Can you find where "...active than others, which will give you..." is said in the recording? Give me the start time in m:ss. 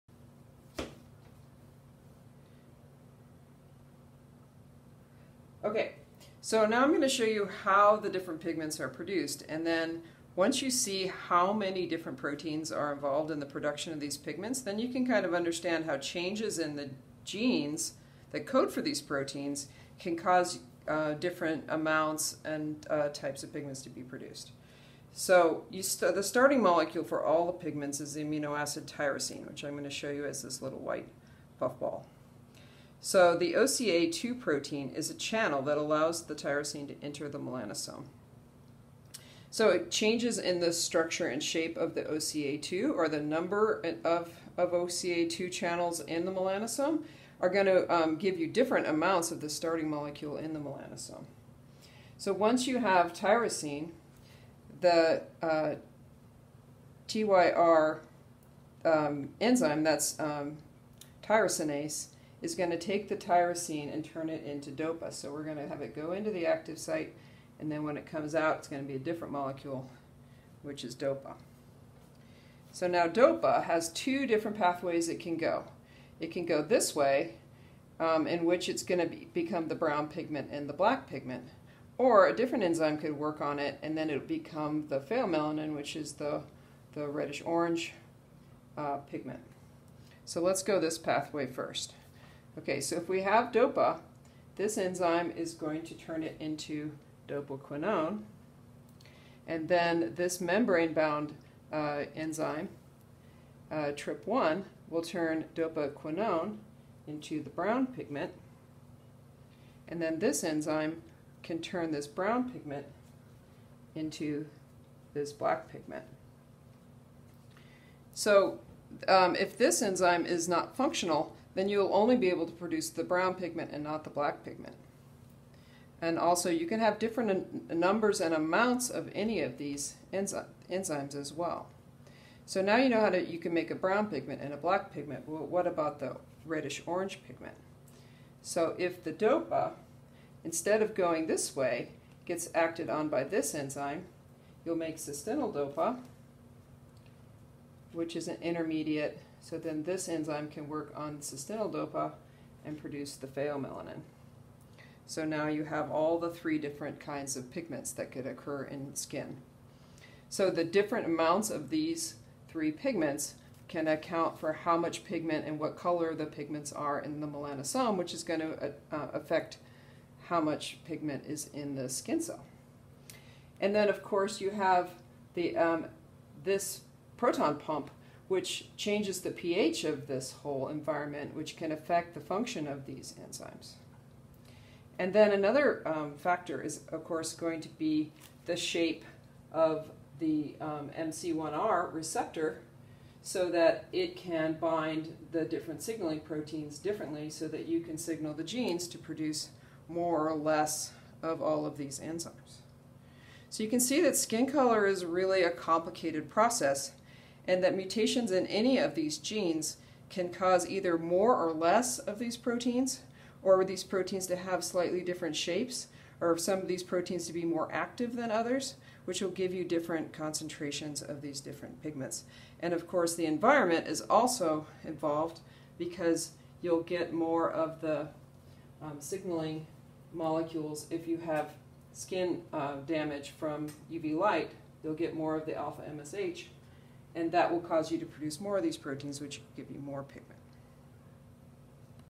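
3:37.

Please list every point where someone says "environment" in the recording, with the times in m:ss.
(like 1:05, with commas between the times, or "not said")
3:00, 3:43.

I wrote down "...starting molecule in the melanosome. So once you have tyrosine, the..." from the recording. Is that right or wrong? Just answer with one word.
right.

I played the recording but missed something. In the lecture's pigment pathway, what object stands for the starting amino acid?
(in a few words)
white puffball.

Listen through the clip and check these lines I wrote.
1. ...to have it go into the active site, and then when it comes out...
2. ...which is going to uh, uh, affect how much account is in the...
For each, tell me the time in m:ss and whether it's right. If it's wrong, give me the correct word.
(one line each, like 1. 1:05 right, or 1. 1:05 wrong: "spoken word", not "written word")
1. 1:05 right
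2. 2:47 wrong: "pigment", not "account".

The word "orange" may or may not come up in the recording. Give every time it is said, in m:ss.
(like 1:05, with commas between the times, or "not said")
1:27, 2:16.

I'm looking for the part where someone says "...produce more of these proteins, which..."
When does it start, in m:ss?
3:58.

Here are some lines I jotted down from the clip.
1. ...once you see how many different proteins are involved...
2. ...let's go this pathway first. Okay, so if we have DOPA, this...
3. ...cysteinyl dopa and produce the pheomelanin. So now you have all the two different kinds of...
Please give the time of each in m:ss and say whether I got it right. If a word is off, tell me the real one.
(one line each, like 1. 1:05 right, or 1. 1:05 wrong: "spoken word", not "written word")
1. 0:10 right
2. 1:30 right
3. 2:31 wrong: "three", not "two".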